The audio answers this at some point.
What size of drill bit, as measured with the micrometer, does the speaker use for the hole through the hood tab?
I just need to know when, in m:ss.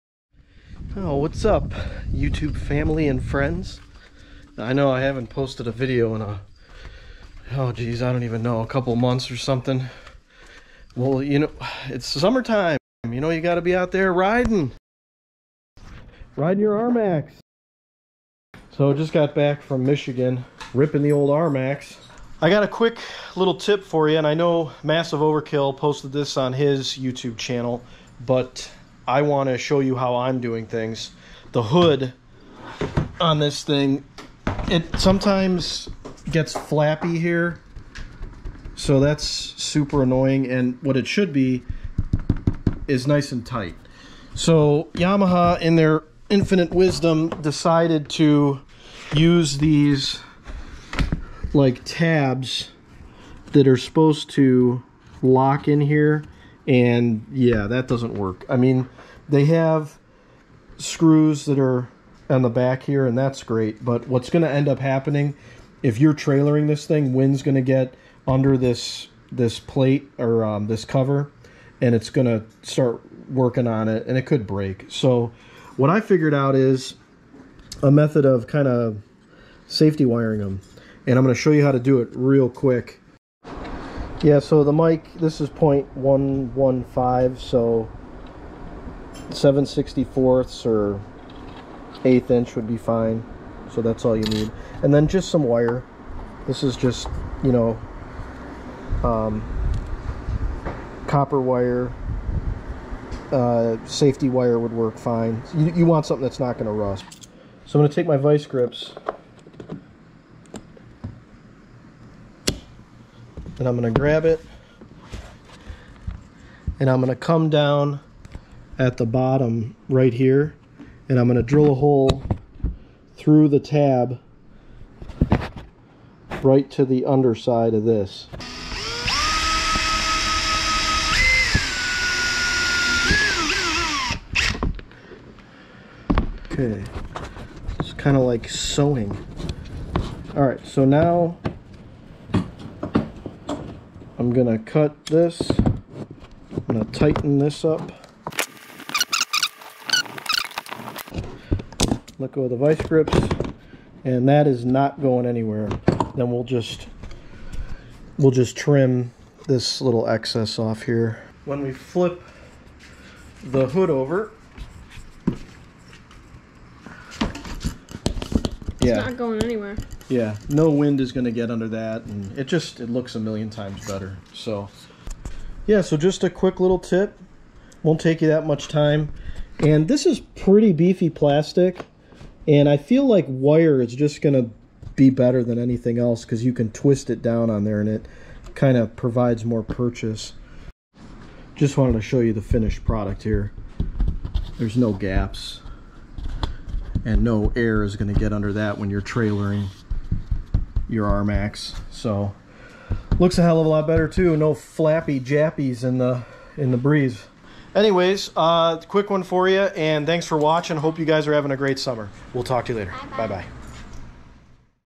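1:25.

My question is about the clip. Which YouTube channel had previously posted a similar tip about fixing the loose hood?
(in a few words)
Massive Overkill.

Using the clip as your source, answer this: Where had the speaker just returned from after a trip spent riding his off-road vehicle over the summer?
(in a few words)
Michigan.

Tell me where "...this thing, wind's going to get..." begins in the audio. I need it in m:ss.
1:06.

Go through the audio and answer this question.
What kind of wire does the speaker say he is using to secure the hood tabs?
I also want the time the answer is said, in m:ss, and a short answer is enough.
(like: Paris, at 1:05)
Copper wire, at 1:41.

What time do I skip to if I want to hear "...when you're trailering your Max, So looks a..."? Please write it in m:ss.
3:18.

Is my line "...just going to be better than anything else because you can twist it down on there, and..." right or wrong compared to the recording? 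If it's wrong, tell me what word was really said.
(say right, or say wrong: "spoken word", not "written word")
right.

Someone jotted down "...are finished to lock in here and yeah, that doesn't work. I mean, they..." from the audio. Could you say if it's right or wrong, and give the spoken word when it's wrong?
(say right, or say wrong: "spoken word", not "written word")
wrong: "supposed", not "finished".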